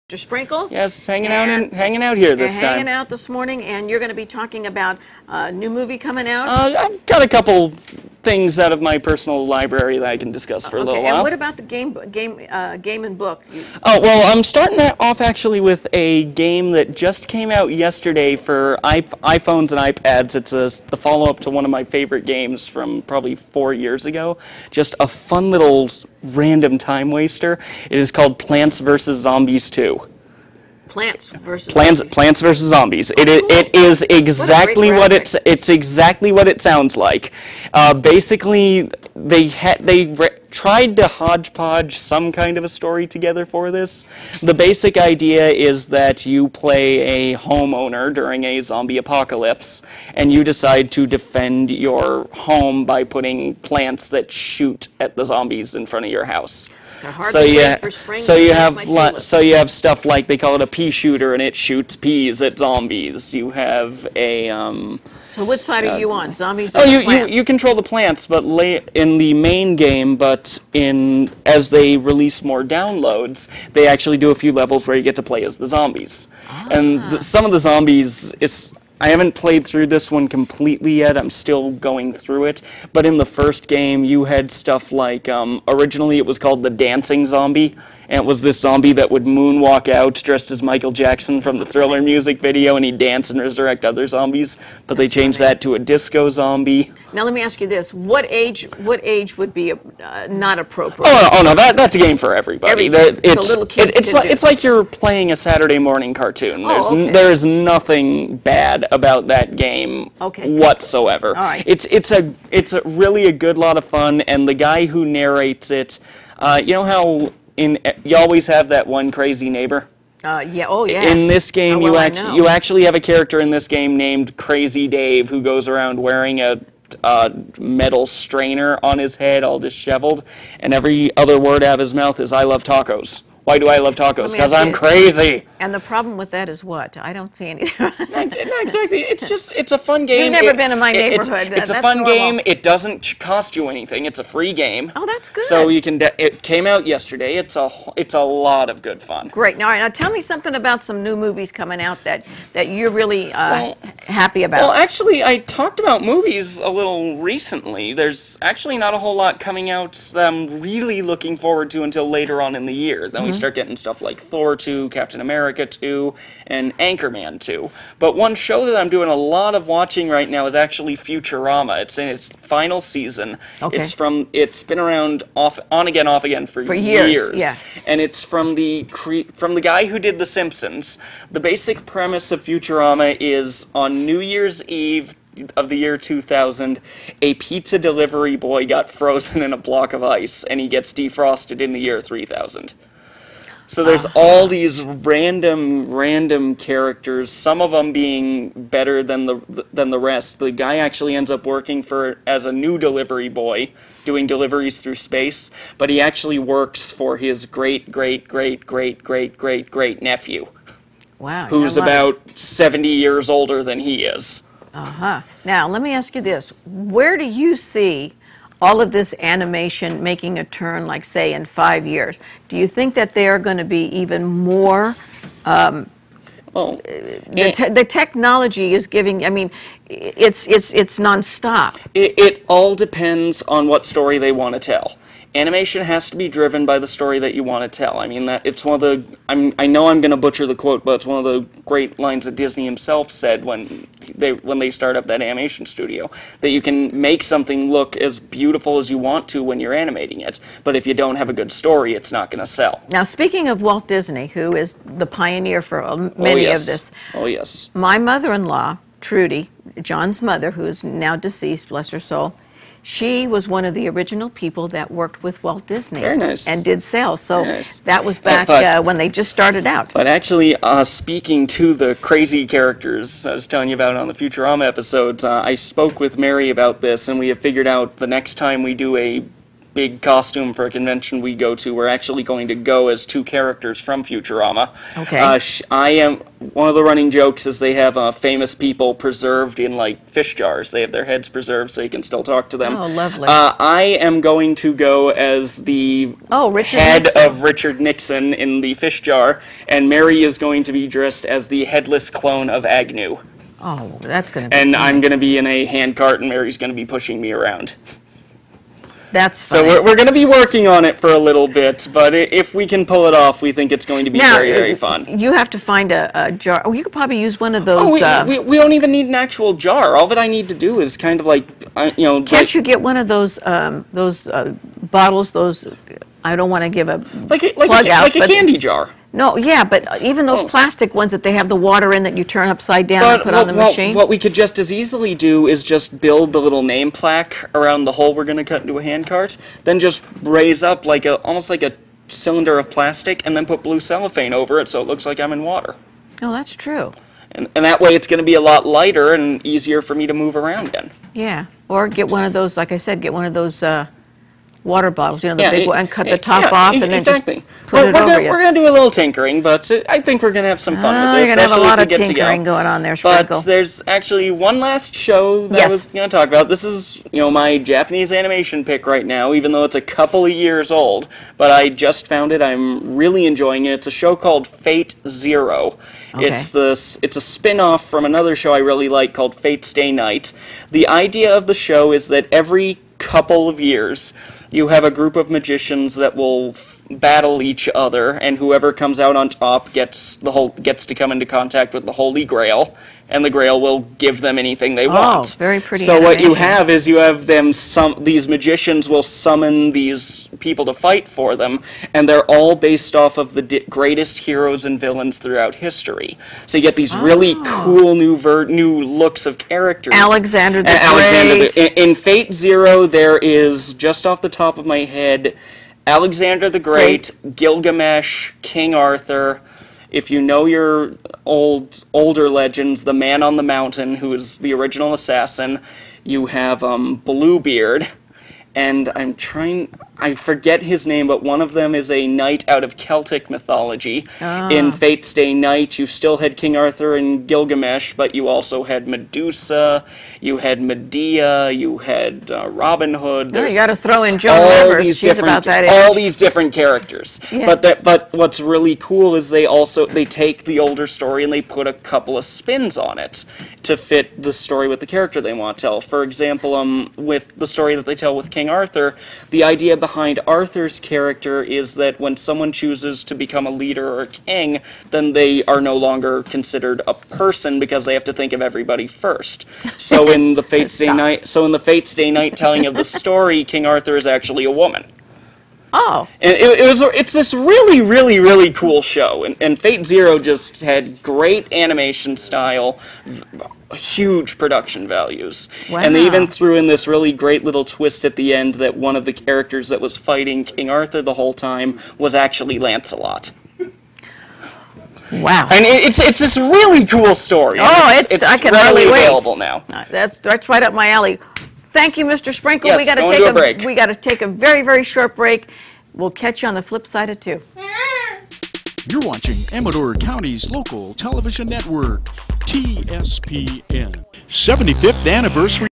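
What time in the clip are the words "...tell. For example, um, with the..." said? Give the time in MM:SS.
07:35.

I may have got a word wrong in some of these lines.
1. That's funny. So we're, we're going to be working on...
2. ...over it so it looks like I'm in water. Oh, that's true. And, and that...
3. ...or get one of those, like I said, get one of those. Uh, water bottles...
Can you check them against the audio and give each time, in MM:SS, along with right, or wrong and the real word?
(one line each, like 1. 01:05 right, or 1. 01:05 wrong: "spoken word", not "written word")
1. 05:09 right
2. 05:44 right
3. 05:51 right.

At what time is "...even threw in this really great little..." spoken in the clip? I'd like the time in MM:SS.
08:06.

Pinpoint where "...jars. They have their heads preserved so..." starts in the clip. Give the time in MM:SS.
04:50.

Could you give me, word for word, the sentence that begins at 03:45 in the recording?
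Um, well, uh, the, te the, technology is giving.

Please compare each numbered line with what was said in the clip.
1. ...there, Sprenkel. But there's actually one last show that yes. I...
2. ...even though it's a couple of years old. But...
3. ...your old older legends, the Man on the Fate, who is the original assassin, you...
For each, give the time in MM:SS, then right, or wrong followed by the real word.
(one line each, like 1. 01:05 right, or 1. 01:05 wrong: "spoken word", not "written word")
1. 06:02 right
2. 06:09 right
3. 07:00 wrong: "Mountain", not "Fate".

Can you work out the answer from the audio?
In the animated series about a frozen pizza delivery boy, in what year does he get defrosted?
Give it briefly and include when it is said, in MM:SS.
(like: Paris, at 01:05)
3000, at 03:11.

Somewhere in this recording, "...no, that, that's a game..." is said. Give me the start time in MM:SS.
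01:41.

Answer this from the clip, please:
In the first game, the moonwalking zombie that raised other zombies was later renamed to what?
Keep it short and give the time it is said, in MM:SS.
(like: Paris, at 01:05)
disco zombie, at 01:35.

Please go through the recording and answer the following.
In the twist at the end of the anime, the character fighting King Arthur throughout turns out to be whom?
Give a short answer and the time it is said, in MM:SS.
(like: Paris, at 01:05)
Lancelot, at 08:12.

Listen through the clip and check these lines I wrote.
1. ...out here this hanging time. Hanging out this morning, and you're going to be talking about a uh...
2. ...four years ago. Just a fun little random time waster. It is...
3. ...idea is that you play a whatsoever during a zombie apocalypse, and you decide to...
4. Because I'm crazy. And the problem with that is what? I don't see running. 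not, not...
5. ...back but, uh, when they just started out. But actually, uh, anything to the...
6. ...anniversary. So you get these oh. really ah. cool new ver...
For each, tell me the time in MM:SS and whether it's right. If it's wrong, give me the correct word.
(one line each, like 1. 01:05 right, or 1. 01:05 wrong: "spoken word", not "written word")
1. 00:02 right
2. 00:23 right
3. 00:44 wrong: "homeowner", not "whatsoever"
4. 02:14 wrong: "anything", not "running"
5. 04:28 wrong: "speaking", not "anything"
6. 06:45 wrong: "history", not "anniversary".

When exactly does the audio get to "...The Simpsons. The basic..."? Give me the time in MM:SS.
03:00.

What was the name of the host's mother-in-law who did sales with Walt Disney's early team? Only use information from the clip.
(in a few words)
Trudy.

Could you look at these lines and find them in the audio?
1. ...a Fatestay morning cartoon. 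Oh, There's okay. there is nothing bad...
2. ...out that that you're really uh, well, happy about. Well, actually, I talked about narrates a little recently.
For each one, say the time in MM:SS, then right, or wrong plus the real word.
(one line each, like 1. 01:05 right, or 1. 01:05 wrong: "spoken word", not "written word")
1. 01:45 wrong: "Saturday", not "Fatestay"
2. 02:31 wrong: "movies", not "narrates".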